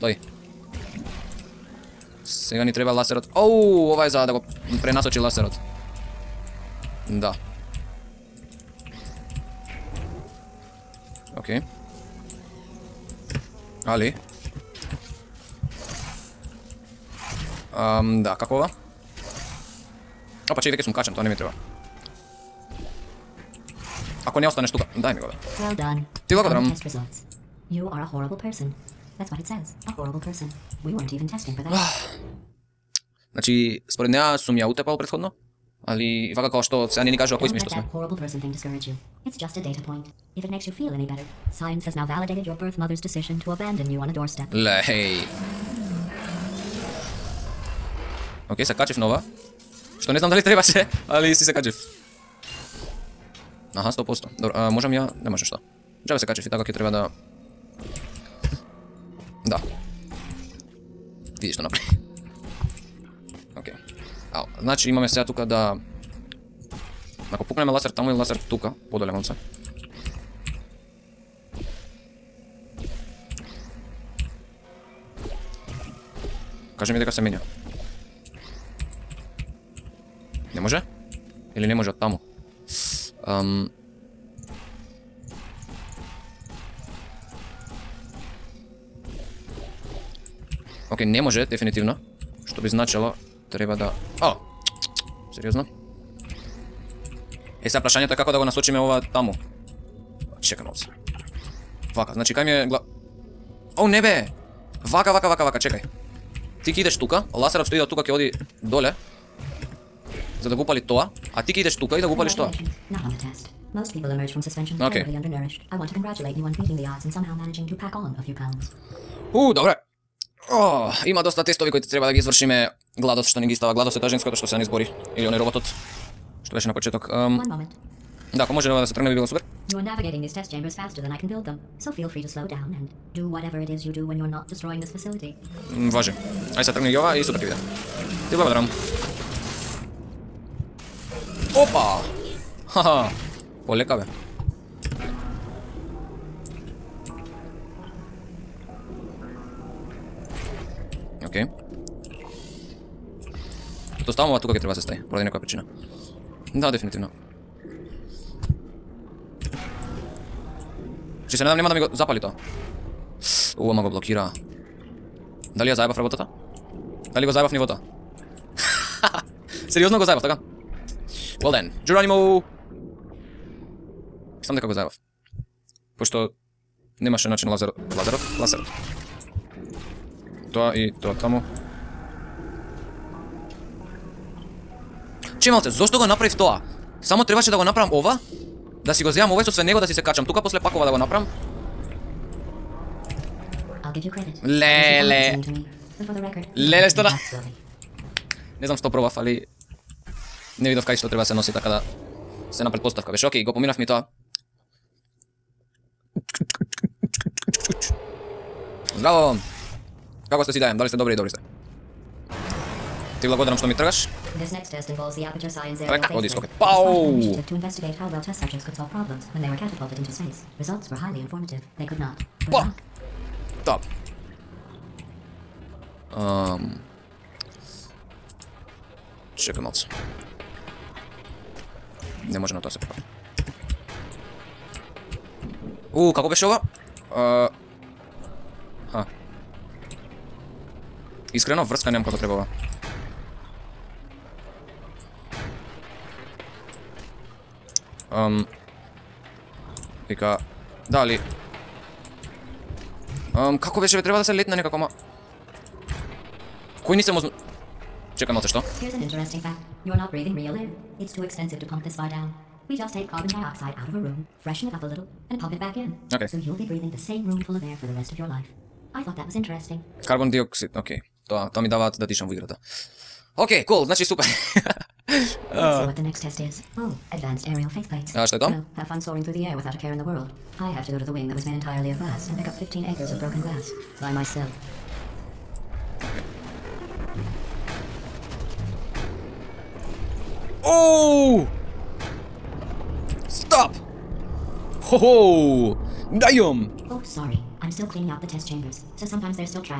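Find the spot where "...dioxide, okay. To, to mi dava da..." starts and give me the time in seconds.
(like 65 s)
270 s.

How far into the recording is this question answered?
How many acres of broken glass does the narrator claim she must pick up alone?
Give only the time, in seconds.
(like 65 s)
282 s.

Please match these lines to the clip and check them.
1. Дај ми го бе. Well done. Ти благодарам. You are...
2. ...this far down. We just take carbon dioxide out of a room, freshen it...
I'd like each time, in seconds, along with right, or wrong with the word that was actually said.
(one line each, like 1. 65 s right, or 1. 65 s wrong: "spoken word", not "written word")
1. 24 s right
2. 261 s right.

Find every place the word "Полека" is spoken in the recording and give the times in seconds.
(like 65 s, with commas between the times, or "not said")
143 s.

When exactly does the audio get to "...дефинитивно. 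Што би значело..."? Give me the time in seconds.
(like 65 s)
91 s.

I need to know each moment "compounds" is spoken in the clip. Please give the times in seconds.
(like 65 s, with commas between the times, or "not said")
not said.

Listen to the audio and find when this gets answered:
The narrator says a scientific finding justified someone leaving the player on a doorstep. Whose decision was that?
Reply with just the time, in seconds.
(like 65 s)
42 s.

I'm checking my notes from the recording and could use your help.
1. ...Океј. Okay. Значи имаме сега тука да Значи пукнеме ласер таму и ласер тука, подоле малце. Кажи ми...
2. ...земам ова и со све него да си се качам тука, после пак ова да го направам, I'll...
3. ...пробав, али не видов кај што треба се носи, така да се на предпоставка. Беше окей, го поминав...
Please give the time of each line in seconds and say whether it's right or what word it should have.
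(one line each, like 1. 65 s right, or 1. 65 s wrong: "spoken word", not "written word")
1. 63 s wrong: "Ако", not "Значи"
2. 189 s right
3. 198 s right.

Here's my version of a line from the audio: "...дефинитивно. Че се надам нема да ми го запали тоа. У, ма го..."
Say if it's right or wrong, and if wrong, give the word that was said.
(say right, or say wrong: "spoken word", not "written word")
right.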